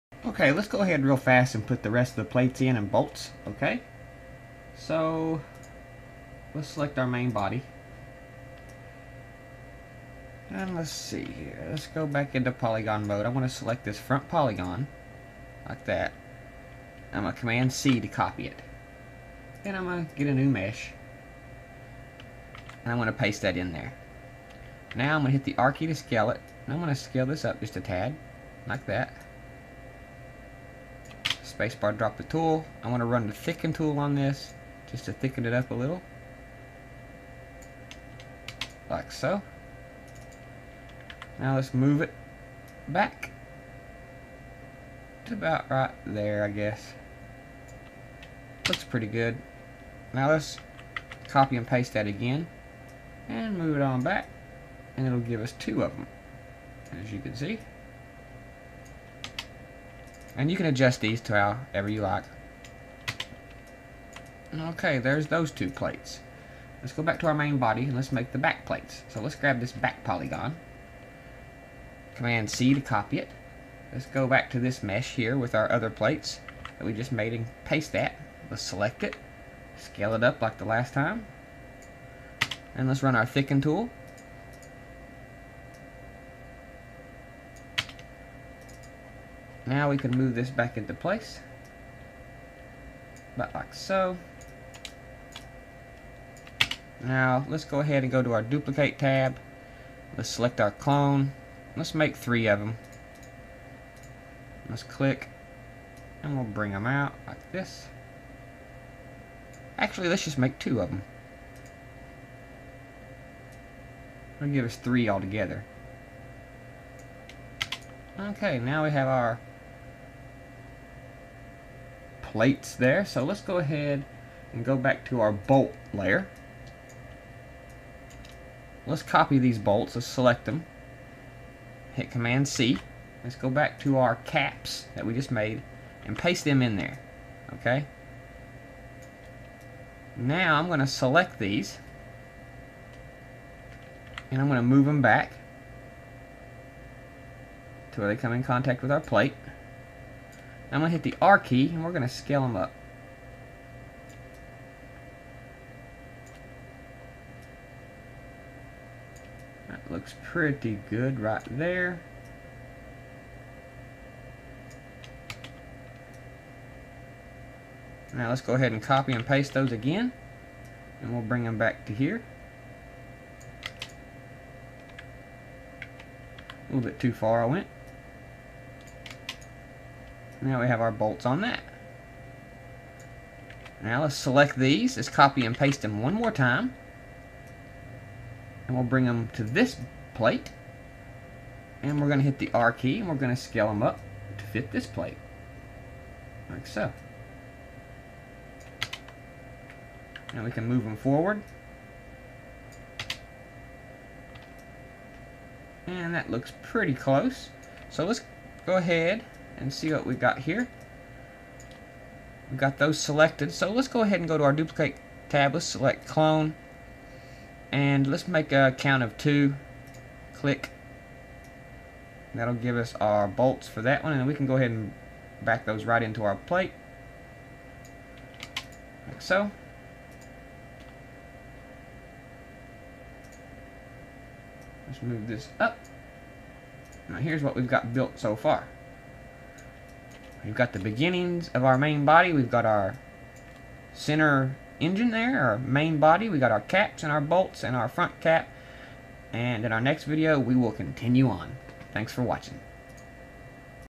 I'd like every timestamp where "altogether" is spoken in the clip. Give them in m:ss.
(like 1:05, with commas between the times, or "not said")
1:55.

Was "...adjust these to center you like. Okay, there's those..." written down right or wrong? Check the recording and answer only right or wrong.
wrong.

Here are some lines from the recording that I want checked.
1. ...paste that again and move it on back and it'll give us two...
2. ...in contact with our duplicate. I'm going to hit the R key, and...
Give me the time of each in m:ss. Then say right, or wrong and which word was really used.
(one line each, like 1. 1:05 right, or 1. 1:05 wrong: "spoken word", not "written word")
1. 0:51 right
2. 2:28 wrong: "plate", not "duplicate".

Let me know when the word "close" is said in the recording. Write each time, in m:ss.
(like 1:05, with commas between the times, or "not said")
3:26.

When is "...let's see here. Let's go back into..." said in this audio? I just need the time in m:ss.
0:10.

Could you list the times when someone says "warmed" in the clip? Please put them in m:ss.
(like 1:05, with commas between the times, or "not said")
not said.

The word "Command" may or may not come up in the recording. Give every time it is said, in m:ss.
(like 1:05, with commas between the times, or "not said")
0:17, 1:12, 2:12.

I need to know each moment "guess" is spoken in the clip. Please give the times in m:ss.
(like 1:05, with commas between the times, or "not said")
0:46.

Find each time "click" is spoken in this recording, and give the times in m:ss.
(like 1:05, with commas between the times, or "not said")
1:44, 3:40.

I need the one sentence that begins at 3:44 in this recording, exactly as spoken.
And we can go ahead and back those right into our plate.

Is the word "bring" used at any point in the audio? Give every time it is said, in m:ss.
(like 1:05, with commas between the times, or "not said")
1:46, 2:51, 3:08.